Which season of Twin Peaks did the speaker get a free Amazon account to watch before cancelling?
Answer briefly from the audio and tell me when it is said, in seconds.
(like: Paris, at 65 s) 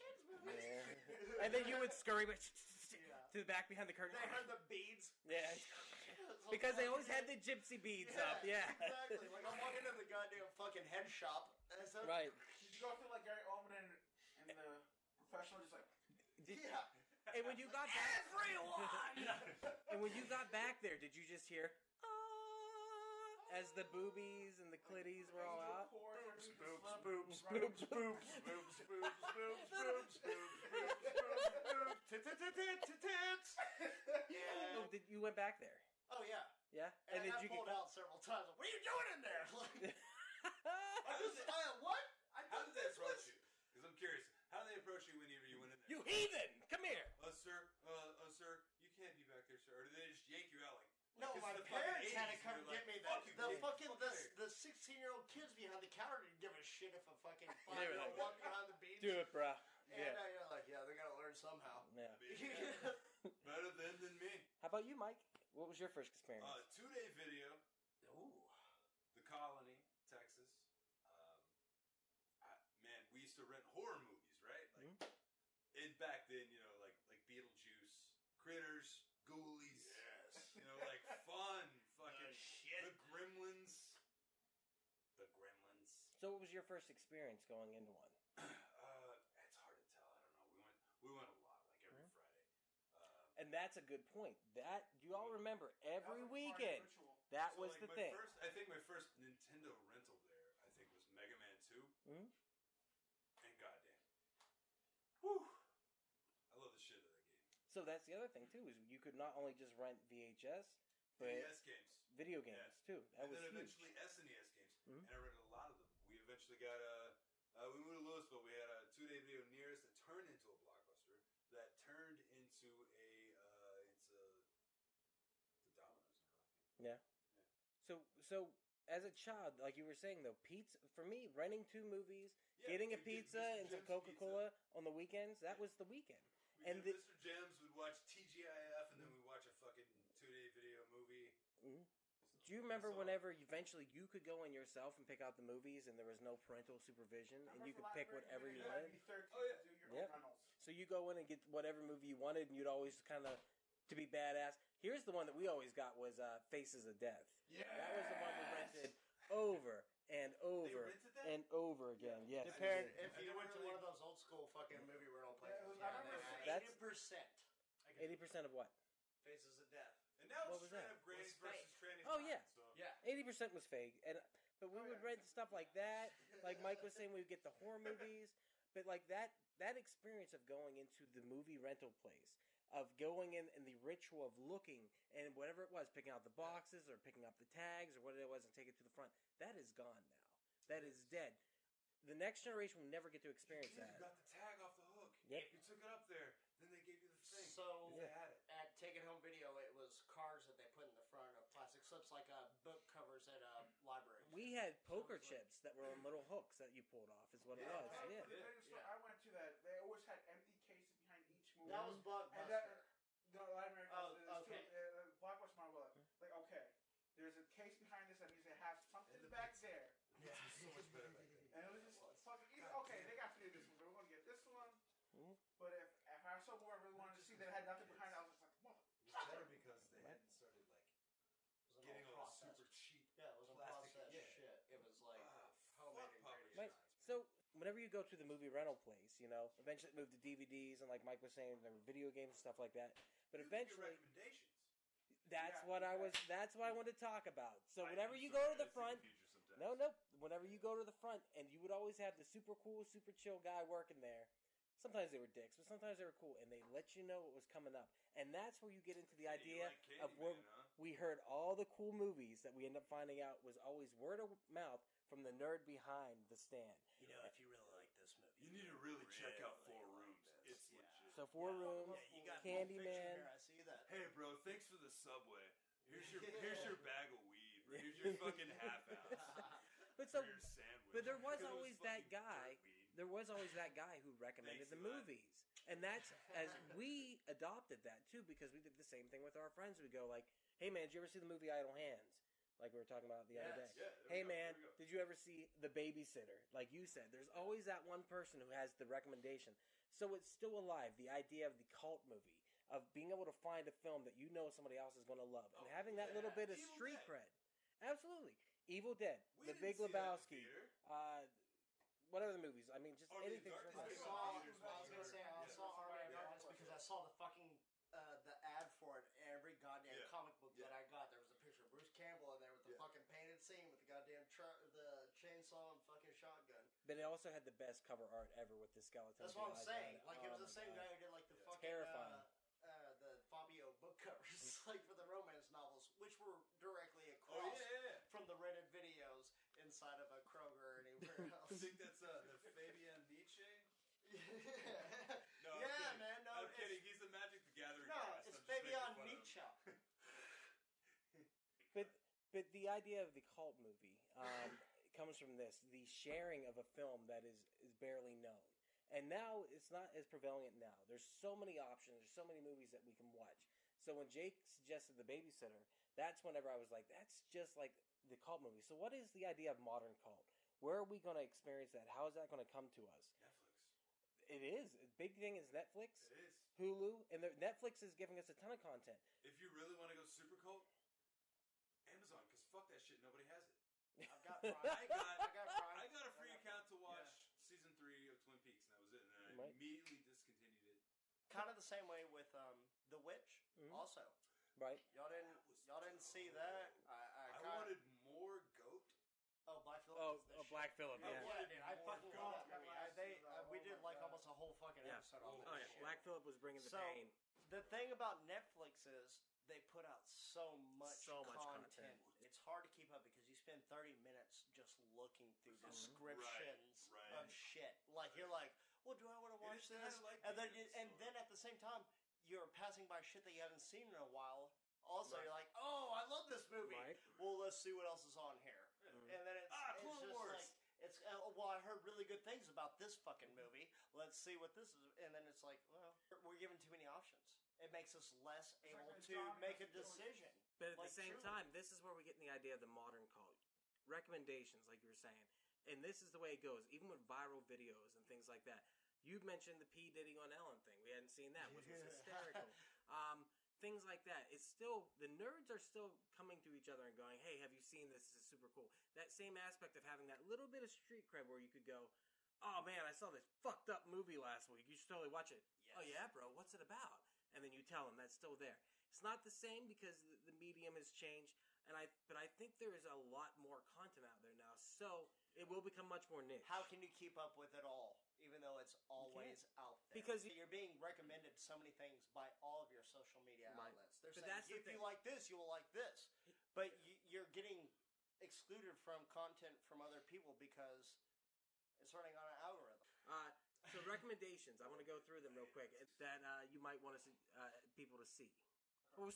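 Season three, at 387 s.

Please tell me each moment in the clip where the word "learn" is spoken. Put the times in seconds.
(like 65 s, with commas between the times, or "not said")
61 s.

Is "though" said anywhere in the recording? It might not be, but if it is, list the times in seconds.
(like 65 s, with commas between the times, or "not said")
130 s, 478 s.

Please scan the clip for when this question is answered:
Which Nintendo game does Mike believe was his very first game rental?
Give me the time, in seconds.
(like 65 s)
101 s.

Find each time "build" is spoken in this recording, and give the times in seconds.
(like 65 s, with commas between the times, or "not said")
not said.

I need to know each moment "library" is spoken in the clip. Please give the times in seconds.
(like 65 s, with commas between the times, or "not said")
203 s.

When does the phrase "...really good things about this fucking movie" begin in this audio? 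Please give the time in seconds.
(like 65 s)
431 s.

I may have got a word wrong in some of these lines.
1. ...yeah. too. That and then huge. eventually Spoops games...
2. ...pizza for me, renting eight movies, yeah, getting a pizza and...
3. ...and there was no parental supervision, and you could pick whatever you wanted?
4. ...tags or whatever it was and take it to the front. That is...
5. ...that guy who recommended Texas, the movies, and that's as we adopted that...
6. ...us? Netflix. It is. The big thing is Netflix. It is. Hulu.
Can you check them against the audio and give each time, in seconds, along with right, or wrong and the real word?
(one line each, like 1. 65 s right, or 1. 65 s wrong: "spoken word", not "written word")
1. 112 s wrong: "SNES", not "Spoops"
2. 130 s wrong: "two", not "eight"
3. 145 s right
4. 187 s right
5. 283 s wrong: "Thanks", not "Texas"
6. 372 s right.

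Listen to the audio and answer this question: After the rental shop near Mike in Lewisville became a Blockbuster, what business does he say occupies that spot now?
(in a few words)
Domino's.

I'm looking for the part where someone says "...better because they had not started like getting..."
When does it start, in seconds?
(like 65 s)
229 s.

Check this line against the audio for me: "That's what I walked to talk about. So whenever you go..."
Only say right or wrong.
wrong.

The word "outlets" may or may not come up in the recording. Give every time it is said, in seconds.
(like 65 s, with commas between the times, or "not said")
483 s.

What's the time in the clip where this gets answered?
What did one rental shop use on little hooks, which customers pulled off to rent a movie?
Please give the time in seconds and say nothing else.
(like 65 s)
204 s.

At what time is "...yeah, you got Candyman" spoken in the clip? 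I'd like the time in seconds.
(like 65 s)
272 s.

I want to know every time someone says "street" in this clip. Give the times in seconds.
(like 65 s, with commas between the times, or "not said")
306 s, 460 s.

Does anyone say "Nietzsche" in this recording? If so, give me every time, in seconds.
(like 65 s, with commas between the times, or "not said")
343 s, 349 s.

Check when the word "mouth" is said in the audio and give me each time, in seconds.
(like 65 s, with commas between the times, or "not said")
264 s.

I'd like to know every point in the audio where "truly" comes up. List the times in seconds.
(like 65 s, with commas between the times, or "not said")
441 s.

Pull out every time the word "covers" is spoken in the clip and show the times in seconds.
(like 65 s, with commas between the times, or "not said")
202 s, 327 s, 333 s.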